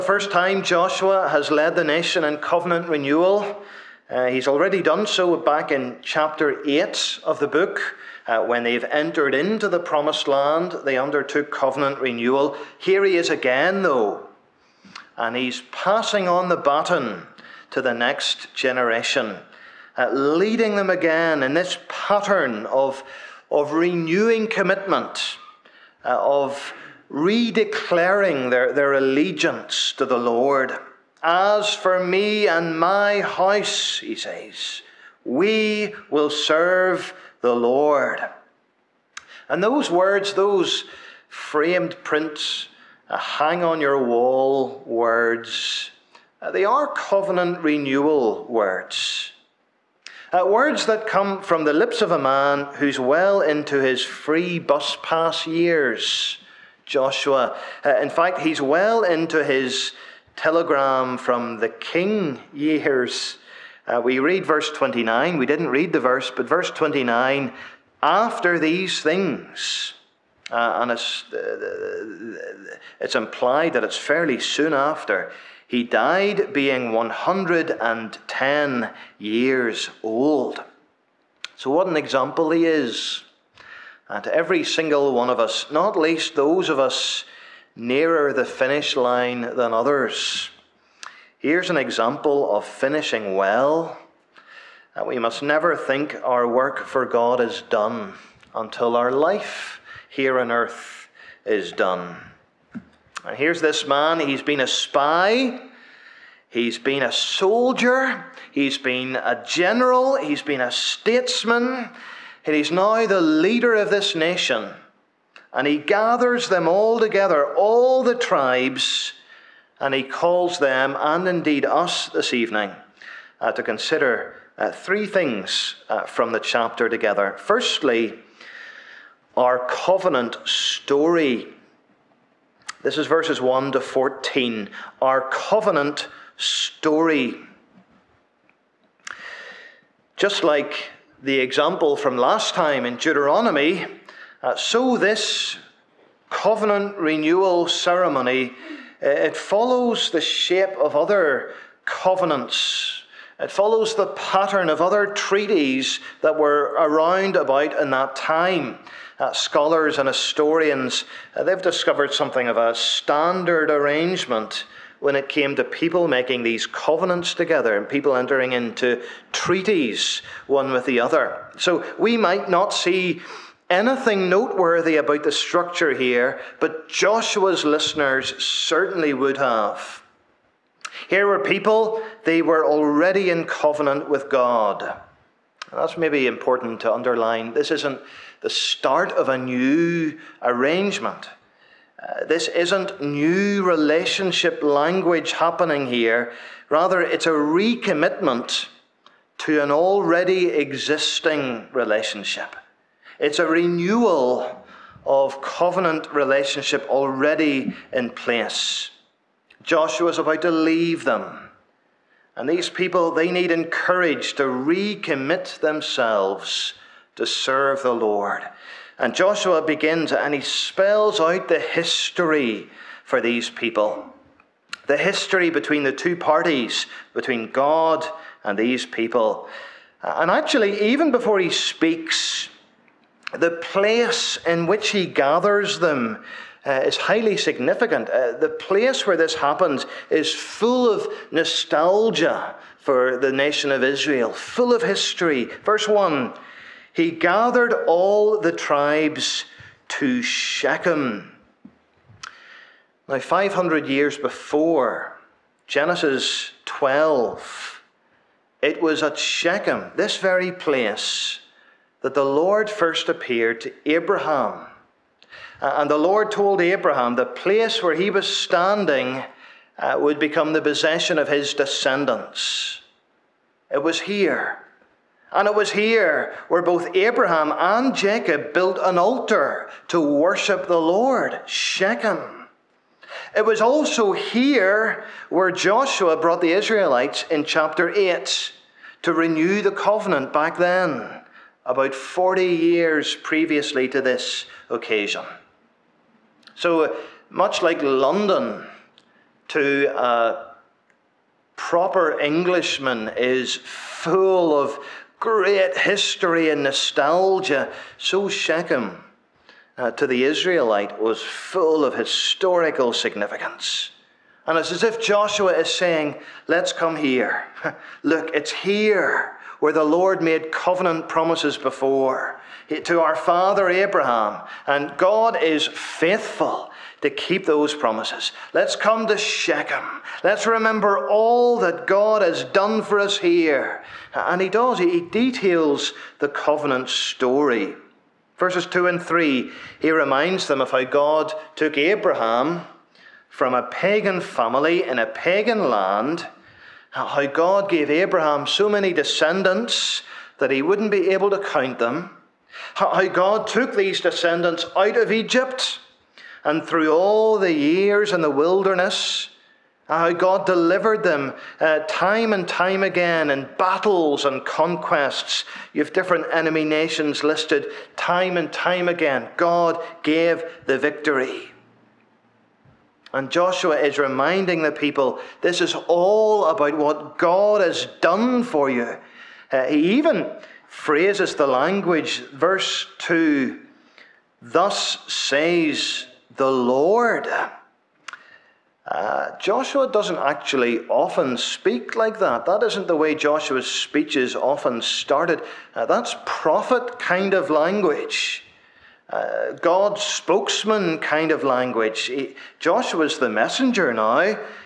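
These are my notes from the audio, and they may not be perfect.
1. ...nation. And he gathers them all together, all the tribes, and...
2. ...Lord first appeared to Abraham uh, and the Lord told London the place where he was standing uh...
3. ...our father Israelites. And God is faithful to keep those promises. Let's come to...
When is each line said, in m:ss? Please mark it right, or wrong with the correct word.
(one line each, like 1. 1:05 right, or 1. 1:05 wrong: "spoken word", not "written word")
1. 1:54 right
2. 4:22 wrong: "Abraham", not "London"
3. 5:23 wrong: "Abraham", not "Israelites".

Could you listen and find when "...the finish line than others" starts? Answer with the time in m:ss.
1:28.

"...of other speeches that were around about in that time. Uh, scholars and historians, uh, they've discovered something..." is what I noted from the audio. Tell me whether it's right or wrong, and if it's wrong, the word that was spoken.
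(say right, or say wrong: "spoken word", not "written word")
wrong: "treaties", not "speeches".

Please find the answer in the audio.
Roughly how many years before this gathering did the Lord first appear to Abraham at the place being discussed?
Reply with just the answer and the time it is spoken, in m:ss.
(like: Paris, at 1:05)
500, at 4:13.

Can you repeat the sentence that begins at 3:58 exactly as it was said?
Uh, the place where this happens is full of nostalgia for the nation of Israel, full of history.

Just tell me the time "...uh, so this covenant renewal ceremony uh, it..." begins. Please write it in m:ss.
2:24.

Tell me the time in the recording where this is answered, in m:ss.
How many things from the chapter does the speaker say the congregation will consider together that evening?
2:04.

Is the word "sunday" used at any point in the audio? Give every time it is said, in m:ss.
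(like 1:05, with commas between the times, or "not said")
not said.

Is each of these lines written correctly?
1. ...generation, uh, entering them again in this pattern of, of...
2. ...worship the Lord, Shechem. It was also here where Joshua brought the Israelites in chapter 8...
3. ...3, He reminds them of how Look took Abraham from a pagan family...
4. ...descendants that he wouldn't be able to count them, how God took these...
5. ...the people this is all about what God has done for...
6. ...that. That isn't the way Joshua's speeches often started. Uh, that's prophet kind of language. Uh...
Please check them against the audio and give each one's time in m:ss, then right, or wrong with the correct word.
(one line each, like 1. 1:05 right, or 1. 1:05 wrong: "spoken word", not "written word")
1. 0:18 wrong: "leading", not "entering"
2. 4:40 right
3. 5:39 wrong: "God", not "Look"
4. 5:48 right
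5. 6:14 right
6. 6:32 right.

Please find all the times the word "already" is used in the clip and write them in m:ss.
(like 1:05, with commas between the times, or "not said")
0:04, 3:02, 3:19, 3:26.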